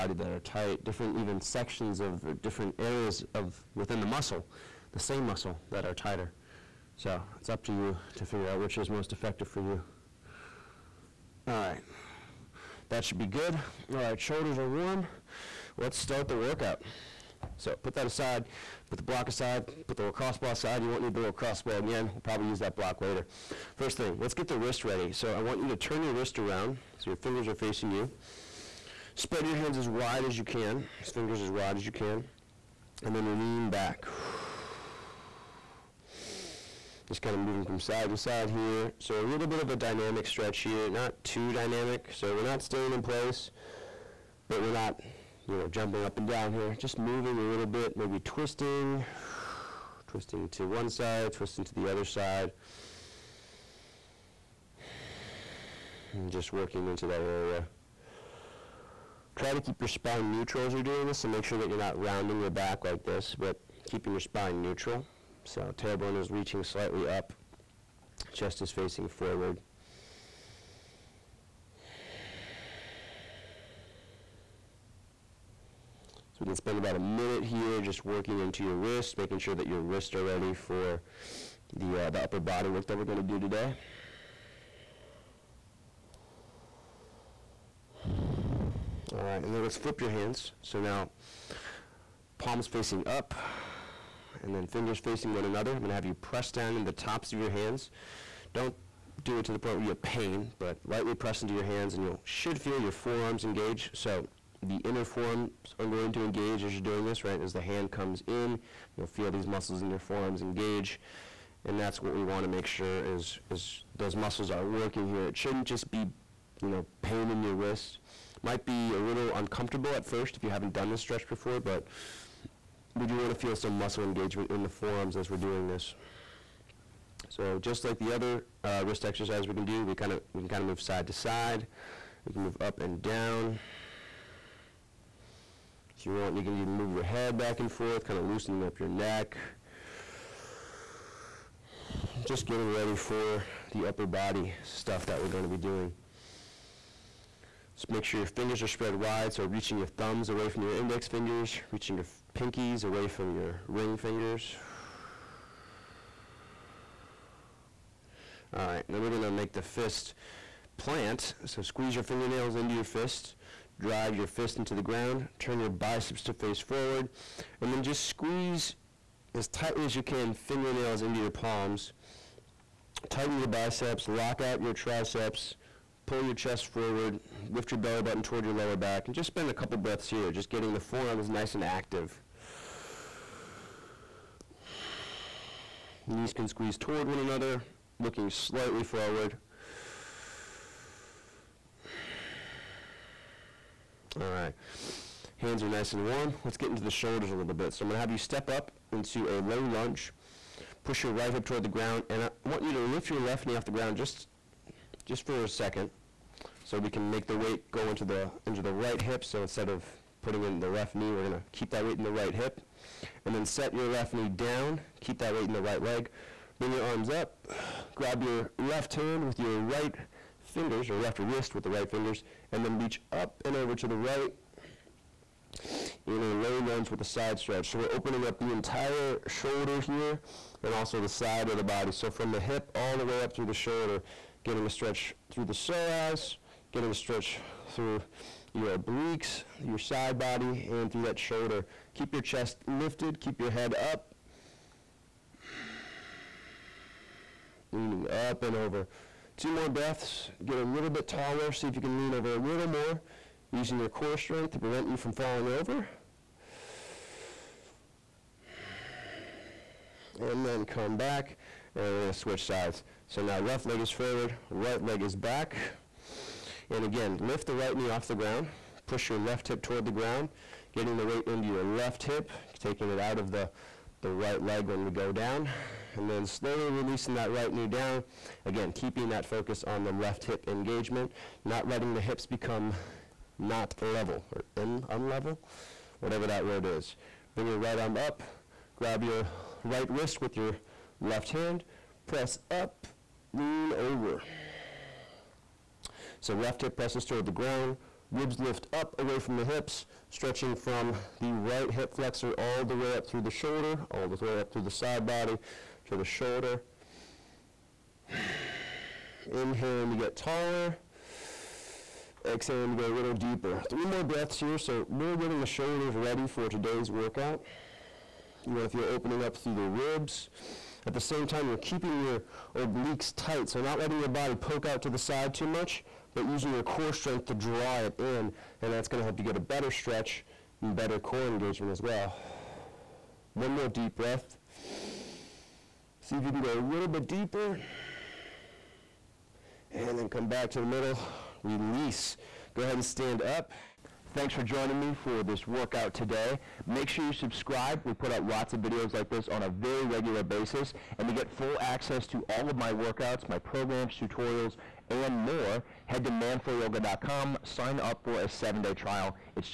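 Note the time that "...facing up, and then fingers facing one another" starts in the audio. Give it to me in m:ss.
1:32.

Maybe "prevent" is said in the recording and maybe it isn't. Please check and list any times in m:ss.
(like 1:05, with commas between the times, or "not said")
4:14.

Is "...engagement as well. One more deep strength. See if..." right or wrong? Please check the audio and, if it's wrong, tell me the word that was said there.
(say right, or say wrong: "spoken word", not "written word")
wrong: "breath", not "strength".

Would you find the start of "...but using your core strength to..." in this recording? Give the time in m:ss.
5:26.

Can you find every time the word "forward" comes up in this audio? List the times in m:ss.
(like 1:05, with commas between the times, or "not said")
1:09, 2:46, 2:56, 3:08, 4:23.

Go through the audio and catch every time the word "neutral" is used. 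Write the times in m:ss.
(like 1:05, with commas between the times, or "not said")
1:00, 1:04.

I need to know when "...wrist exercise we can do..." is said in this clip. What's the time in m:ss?
2:08.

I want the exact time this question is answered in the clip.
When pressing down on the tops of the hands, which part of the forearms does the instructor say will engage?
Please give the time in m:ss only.
1:44.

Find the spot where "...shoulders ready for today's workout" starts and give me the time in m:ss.
5:15.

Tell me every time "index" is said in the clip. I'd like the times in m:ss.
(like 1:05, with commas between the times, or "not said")
2:30.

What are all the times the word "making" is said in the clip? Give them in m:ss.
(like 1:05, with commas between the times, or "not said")
1:19.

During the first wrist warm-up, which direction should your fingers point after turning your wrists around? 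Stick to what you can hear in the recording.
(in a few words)
Facing you.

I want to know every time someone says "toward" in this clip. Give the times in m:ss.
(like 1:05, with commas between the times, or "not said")
2:58, 3:06, 3:21, 4:29, 4:57.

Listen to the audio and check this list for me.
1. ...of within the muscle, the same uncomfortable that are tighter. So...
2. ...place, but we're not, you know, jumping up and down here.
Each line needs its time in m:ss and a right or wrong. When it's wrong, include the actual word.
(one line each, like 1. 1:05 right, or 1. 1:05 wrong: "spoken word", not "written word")
1. 0:03 wrong: "muscle", not "uncomfortable"
2. 0:43 right.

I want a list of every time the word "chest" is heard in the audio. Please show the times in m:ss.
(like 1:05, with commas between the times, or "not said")
1:08, 2:56, 4:02.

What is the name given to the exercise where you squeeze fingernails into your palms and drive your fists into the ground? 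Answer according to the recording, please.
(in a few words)
Fist plant.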